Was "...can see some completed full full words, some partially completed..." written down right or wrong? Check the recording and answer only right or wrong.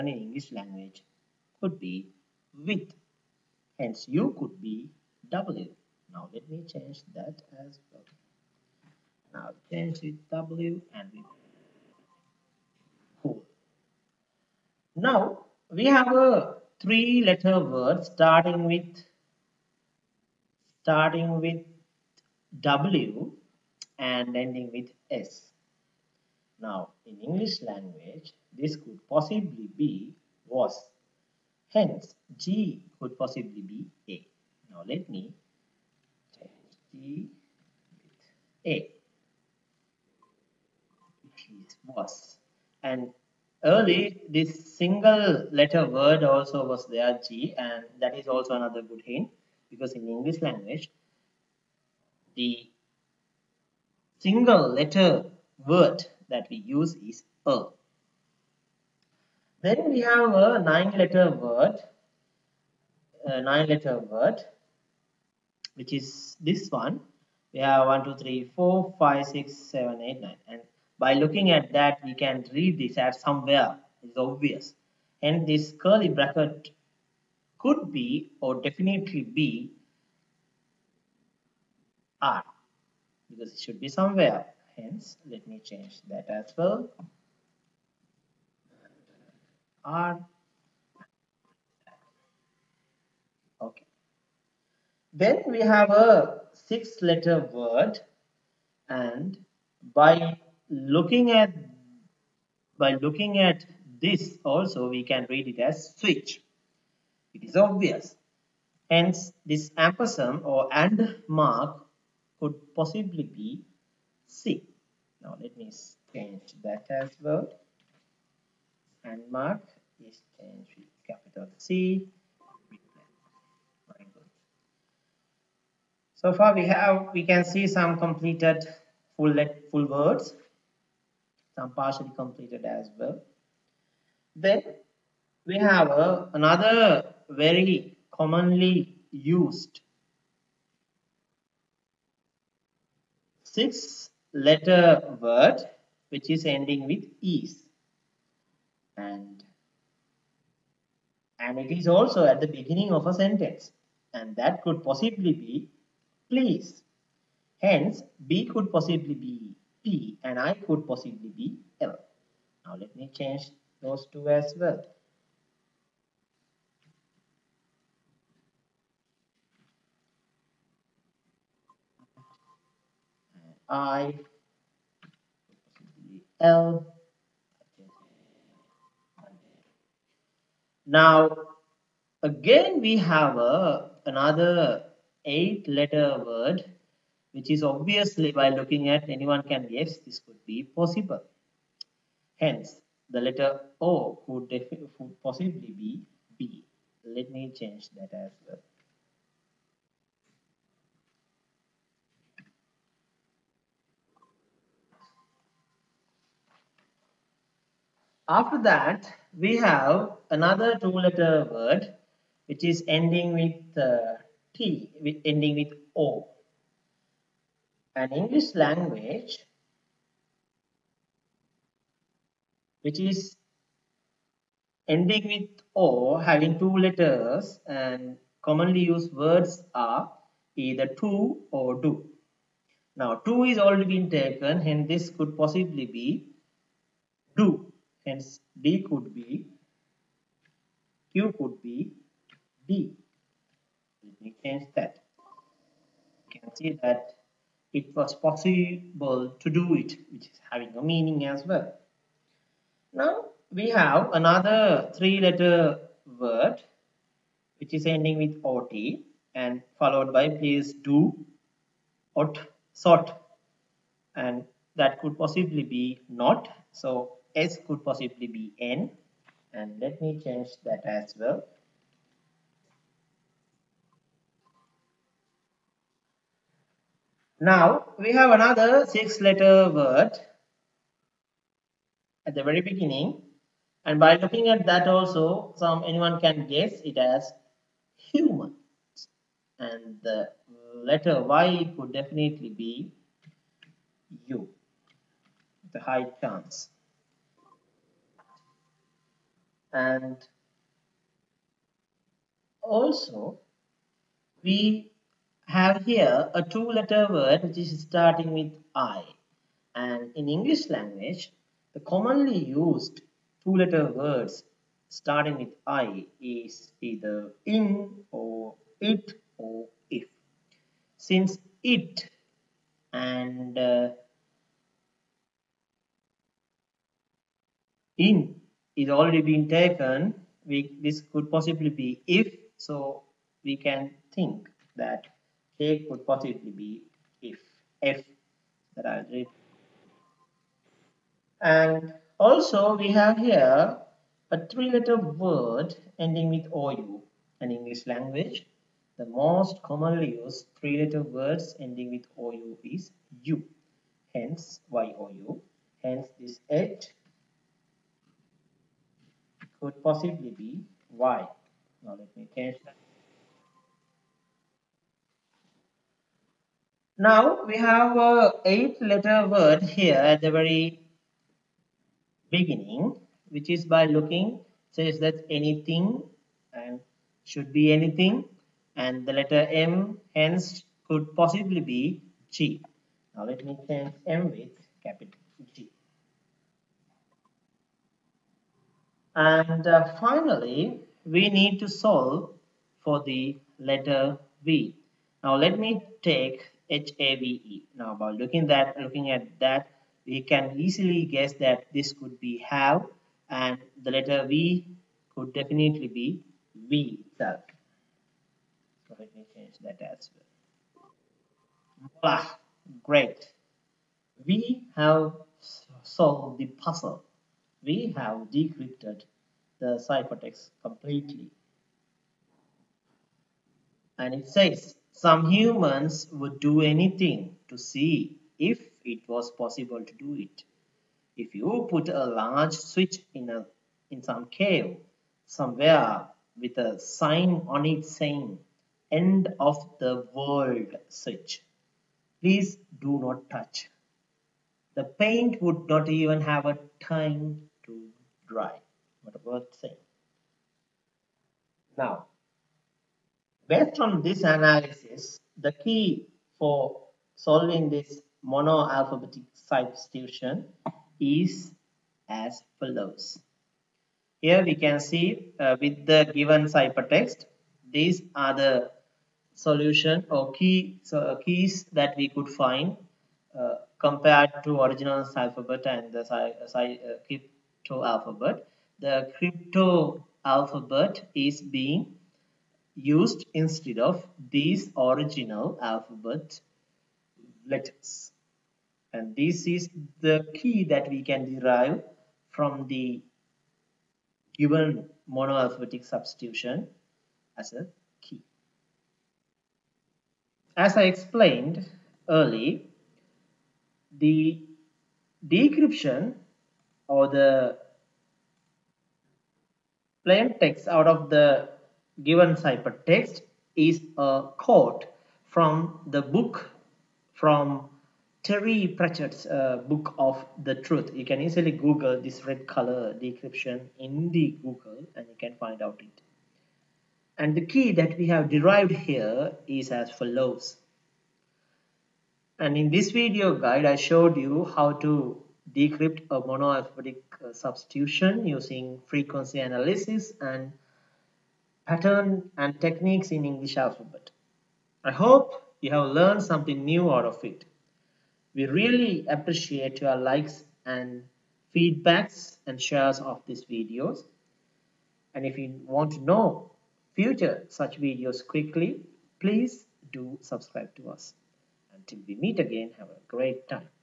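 right.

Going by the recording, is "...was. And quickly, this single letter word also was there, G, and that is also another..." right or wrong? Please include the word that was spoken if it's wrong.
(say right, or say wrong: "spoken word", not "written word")
wrong: "early", not "quickly".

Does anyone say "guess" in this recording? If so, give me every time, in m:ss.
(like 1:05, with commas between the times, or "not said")
3:09, 4:46, 6:41.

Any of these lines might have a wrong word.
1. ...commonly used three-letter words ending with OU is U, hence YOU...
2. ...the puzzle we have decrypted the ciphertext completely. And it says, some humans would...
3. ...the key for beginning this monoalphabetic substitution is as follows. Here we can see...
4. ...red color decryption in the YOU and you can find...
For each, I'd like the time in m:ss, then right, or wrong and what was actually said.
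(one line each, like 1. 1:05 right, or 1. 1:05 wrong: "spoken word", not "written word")
1. 5:49 right
2. 6:56 right
3. 7:35 wrong: "solving", not "beginning"
4. 8:42 wrong: "Google", not "YOU".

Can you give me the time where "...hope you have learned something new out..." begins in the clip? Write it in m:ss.
9:04.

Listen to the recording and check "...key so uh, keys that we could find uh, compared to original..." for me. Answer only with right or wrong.
right.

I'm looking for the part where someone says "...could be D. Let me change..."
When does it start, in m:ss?
4:01.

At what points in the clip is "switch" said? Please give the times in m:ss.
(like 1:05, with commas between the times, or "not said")
1:45, 7:12, 7:20.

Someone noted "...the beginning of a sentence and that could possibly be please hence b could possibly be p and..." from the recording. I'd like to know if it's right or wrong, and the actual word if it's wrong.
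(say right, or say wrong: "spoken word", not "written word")
right.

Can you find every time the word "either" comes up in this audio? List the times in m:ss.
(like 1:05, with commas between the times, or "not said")
3:50, 5:16.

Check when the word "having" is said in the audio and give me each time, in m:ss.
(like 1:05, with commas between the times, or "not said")
3:46, 4:10.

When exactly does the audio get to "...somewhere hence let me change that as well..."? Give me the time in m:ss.
1:23.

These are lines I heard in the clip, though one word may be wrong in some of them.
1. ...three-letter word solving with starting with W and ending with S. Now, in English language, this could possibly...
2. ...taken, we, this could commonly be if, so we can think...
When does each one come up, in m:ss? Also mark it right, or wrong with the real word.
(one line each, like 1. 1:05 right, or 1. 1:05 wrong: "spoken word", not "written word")
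1. 0:16 wrong: "starting", not "solving"
2. 5:29 wrong: "possibly", not "commonly".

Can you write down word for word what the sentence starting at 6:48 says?
So let me change that as well.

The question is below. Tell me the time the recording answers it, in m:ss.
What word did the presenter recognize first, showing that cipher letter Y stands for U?
4:47.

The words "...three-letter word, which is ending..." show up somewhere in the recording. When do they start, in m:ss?
4:14.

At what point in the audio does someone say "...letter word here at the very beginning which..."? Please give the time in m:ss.
6:08.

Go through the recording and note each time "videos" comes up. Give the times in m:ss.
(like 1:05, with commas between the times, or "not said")
8:52, 9:13, 9:17.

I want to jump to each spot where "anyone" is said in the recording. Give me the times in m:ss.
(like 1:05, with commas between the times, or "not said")
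3:09, 4:45.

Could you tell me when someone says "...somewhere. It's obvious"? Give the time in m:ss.
1:13.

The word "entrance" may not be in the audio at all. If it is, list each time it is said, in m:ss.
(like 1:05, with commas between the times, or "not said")
not said.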